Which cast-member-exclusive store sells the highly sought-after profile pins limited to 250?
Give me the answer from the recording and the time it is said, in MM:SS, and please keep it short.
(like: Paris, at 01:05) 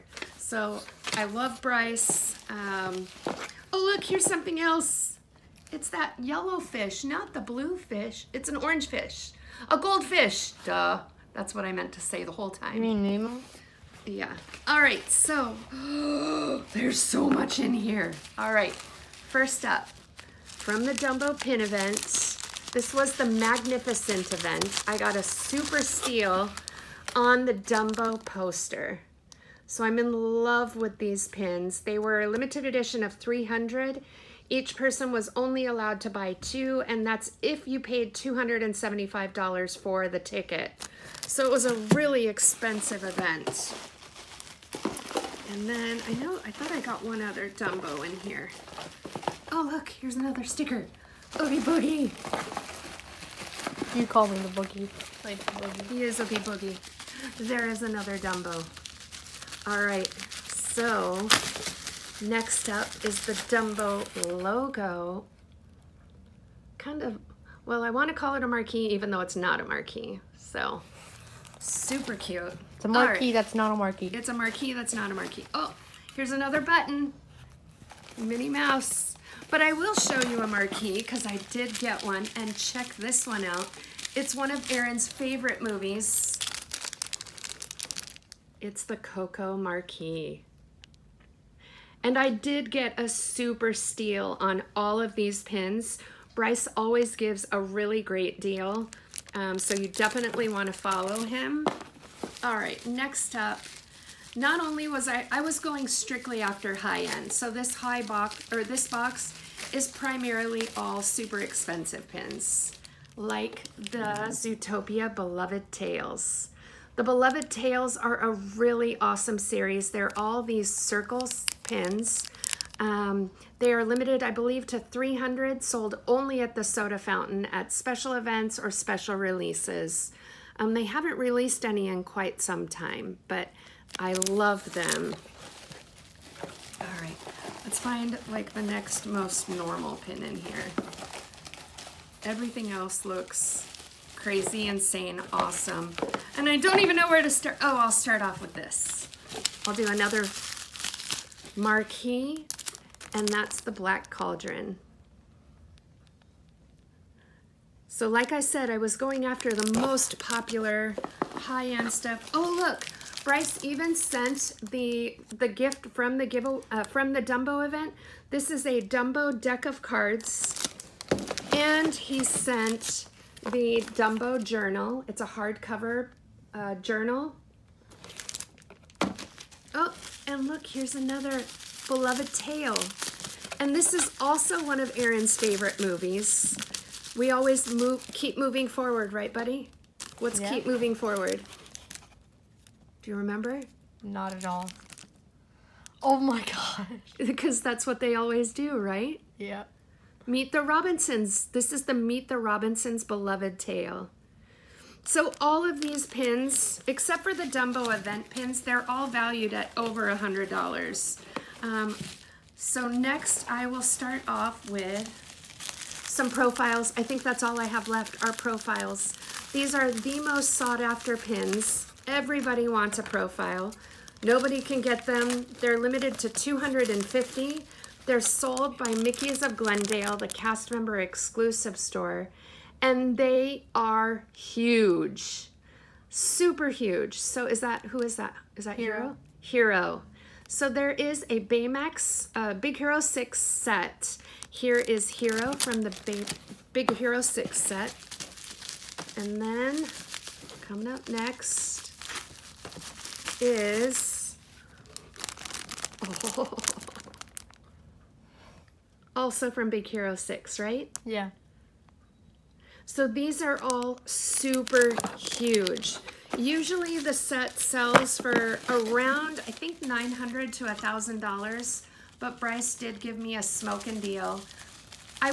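Mickey's of Glendale, at 03:48.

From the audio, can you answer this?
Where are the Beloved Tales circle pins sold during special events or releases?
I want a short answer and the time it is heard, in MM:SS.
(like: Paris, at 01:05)
the soda fountain, at 02:06.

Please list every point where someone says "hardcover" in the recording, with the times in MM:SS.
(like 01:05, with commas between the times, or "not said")
02:55.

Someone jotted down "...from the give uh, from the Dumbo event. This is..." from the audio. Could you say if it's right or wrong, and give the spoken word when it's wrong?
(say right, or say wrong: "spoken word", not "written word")
right.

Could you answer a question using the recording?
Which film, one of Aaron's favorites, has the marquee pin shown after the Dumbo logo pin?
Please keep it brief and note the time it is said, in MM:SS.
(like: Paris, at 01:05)
Coco, at 01:28.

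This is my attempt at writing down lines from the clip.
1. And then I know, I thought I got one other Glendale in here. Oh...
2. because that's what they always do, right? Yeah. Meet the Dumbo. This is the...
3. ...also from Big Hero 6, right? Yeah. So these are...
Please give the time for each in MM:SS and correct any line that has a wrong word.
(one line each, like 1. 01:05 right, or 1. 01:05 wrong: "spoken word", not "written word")
1. 00:45 wrong: "Dumbo", not "Glendale"
2. 03:17 wrong: "Robinsons", not "Dumbo"
3. 04:19 right.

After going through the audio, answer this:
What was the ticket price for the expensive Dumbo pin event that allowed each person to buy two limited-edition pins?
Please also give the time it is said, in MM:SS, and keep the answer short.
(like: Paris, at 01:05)
$275, at 00:38.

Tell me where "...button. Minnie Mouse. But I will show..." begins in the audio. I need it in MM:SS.
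01:16.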